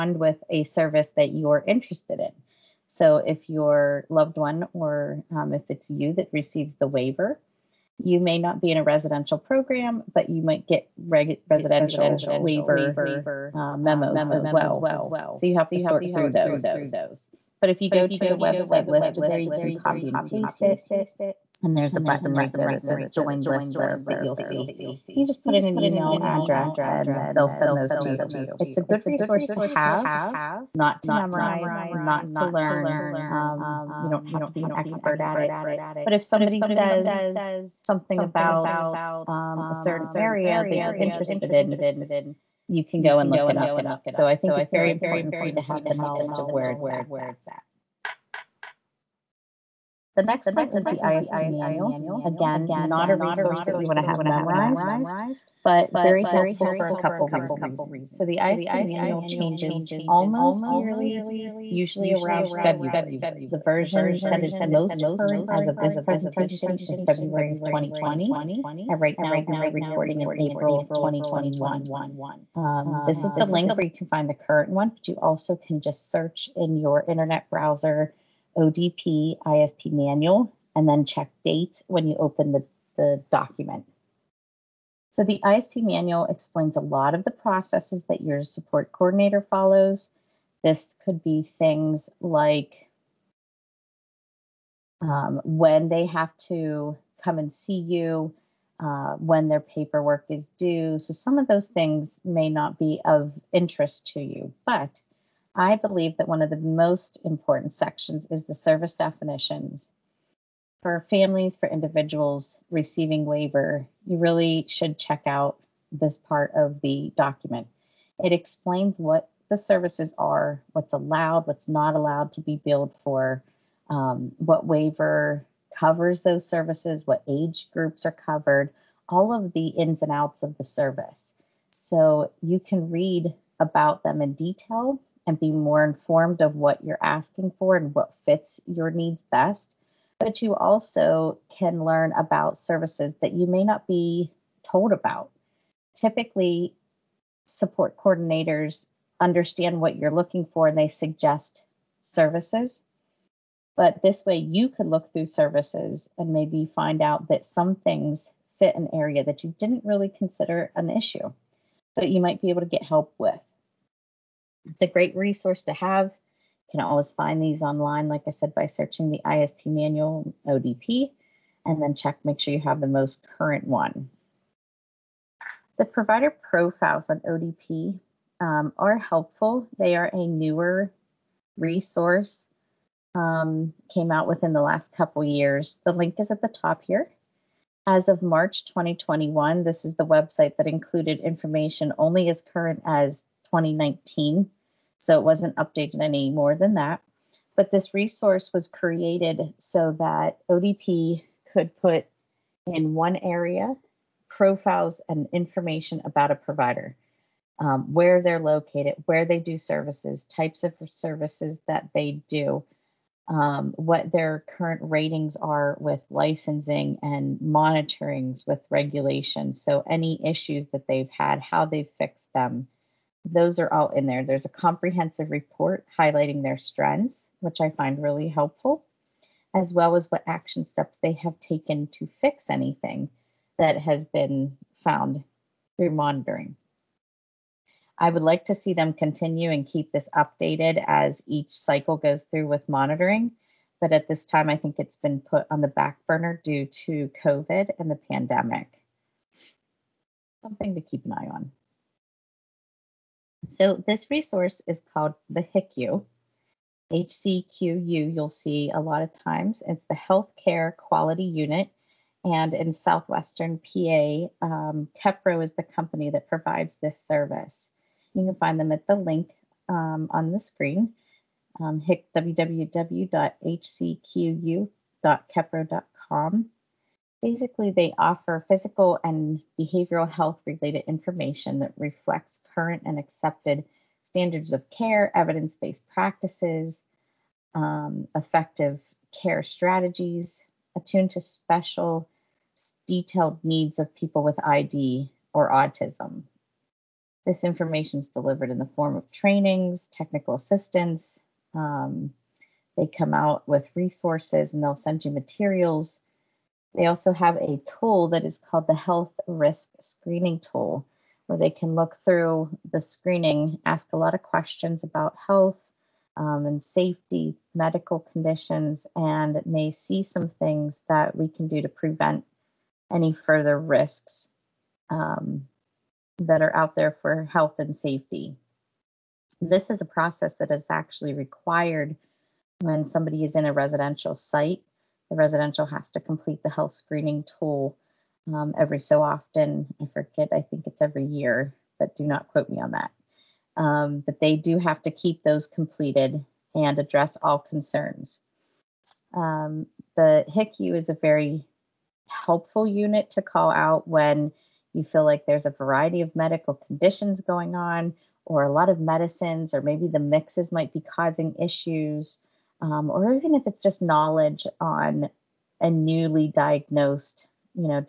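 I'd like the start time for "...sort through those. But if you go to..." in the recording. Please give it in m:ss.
0:15.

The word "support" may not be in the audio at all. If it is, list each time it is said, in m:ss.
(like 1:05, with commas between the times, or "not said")
1:28, 2:27.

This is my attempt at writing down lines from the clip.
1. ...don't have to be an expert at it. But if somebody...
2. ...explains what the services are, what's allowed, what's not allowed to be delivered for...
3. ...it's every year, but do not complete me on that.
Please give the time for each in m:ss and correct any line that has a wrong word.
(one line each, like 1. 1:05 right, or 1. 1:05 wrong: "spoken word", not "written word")
1. 0:34 right
2. 1:58 wrong: "billed", not "delivered"
3. 5:40 wrong: "quote", not "complete".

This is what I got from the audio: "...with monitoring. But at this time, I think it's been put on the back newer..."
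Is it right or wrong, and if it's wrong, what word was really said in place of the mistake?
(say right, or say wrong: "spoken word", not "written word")
wrong: "burner", not "newer".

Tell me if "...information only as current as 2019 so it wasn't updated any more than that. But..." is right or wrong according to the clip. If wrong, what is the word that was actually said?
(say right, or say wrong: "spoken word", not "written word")
right.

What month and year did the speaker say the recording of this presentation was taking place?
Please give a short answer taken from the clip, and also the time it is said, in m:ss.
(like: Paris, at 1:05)
April 2021, at 1:10.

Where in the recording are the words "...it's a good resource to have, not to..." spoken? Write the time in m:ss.
0:28.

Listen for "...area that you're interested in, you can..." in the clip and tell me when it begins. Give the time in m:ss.
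0:40.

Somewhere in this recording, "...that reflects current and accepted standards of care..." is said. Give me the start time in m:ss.
4:41.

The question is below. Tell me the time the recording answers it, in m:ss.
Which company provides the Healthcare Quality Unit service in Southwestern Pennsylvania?
4:24.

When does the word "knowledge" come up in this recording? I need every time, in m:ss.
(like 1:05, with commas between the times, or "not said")
0:45, 6:03.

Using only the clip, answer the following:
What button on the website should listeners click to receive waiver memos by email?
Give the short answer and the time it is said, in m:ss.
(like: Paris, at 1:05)
join listserv, at 0:23.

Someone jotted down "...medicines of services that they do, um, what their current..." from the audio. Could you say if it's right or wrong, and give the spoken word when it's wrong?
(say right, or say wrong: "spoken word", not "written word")
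wrong: "types", not "medicines".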